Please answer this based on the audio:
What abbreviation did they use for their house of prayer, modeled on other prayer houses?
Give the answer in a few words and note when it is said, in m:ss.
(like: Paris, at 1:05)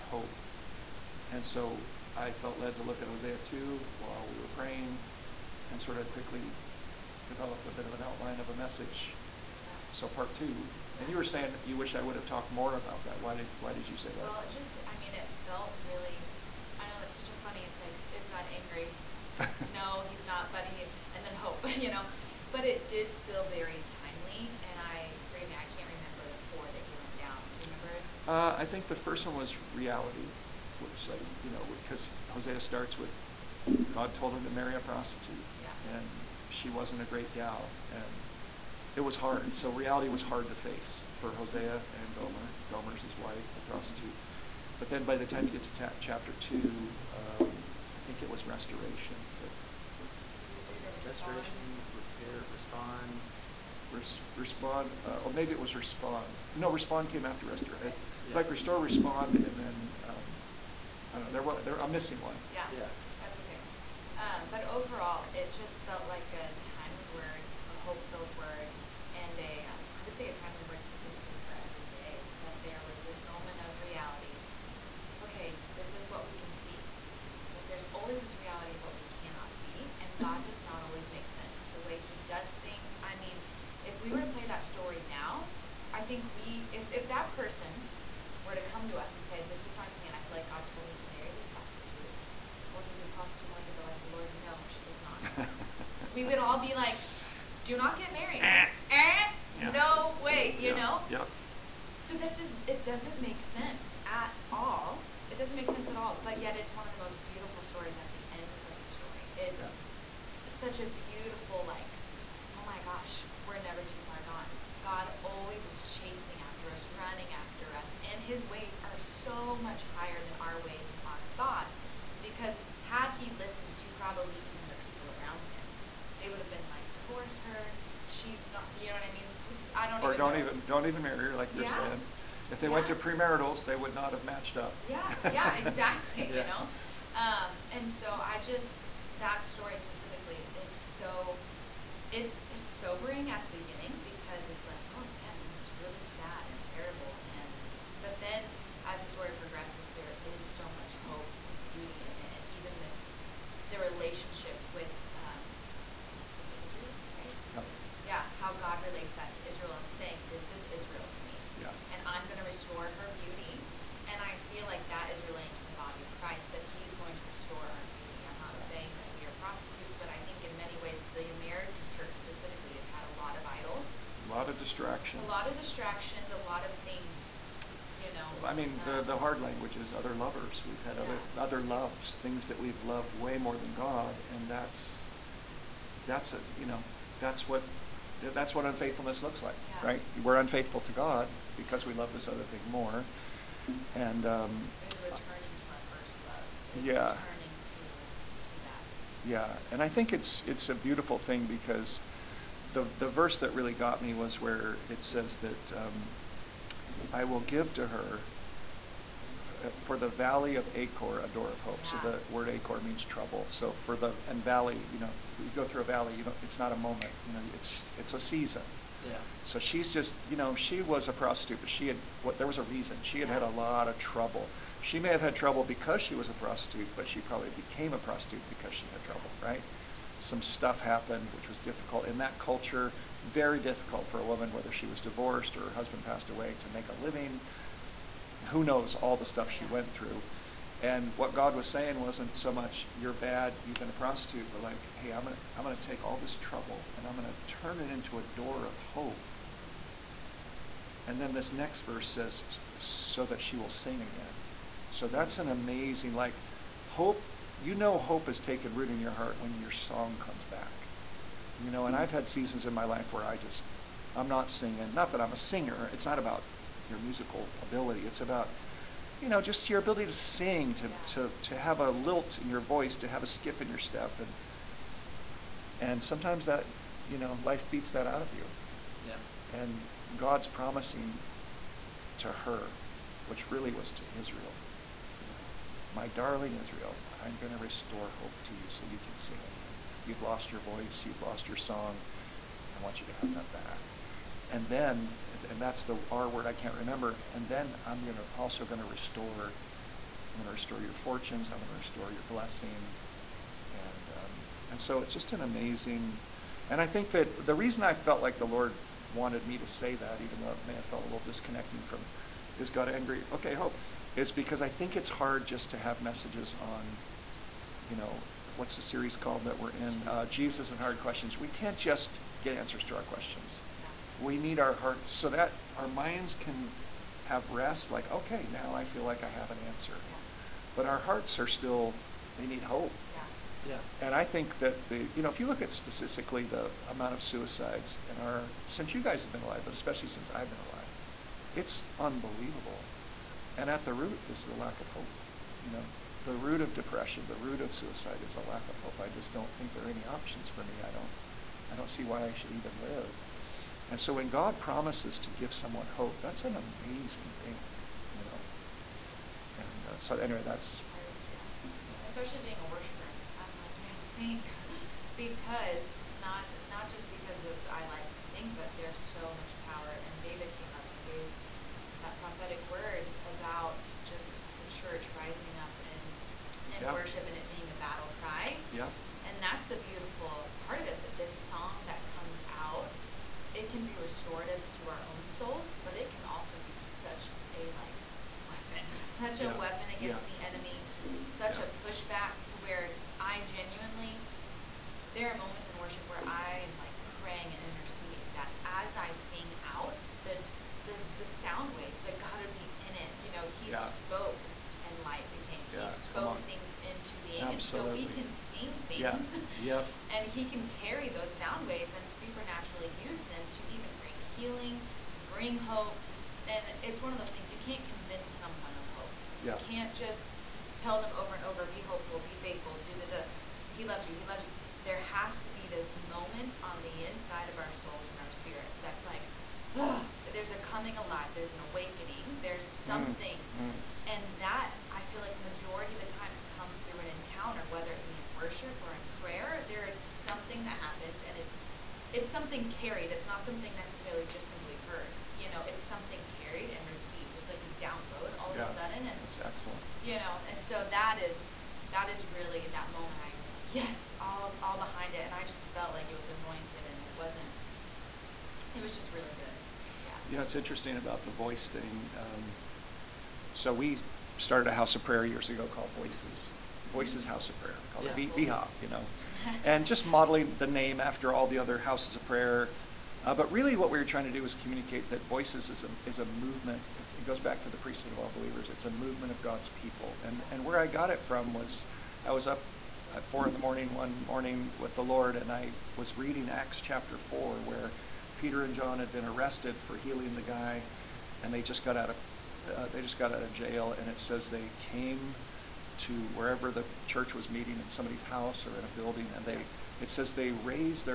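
VHOP, at 7:48.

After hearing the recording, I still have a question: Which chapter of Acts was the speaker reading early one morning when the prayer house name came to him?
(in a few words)
chapter 4.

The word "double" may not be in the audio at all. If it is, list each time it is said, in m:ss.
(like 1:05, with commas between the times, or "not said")
not said.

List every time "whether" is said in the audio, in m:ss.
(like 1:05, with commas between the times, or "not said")
3:54, 7:17.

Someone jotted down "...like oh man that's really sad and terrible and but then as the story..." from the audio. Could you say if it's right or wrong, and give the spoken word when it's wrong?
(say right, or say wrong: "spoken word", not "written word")
right.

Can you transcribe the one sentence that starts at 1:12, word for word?
That there was this moment of reality.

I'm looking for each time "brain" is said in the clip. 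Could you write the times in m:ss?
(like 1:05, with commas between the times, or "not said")
not said.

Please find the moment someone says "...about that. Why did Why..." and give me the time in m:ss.
0:12.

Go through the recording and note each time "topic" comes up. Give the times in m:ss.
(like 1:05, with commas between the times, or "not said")
not said.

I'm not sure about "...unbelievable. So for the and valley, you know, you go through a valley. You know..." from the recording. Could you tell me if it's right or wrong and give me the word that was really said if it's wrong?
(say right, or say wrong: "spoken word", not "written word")
wrong: "trouble", not "unbelievable".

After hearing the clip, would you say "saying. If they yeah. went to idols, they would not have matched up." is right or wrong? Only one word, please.
wrong.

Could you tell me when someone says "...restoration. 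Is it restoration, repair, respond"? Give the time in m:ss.
0:48.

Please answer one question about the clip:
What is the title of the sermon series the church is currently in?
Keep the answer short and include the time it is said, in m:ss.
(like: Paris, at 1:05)
Jesus and Hard Questions, at 5:20.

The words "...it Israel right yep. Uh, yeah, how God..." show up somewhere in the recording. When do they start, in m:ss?
2:36.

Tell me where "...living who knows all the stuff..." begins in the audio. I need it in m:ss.
3:56.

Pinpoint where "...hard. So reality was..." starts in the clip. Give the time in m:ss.
0:39.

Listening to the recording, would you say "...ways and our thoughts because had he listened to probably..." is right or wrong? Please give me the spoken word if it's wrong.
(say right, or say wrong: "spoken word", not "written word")
right.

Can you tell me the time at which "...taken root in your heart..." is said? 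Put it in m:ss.
4:18.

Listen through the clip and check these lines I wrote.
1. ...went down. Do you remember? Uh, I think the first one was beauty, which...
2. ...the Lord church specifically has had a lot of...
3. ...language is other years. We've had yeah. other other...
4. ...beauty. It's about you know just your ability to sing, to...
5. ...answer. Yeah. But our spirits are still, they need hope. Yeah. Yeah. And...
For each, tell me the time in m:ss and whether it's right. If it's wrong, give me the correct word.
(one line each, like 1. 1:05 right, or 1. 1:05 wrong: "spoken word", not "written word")
1. 0:26 wrong: "reality", not "beauty"
2. 2:51 wrong: "American", not "Lord"
3. 2:59 wrong: "lovers", not "years"
4. 4:27 wrong: "ability", not "beauty"
5. 5:29 wrong: "hearts", not "spirits".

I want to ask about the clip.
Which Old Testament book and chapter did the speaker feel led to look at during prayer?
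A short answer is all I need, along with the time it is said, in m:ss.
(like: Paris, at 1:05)
Hosea 2, at 0:03.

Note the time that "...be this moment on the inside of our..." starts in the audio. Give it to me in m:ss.
7:05.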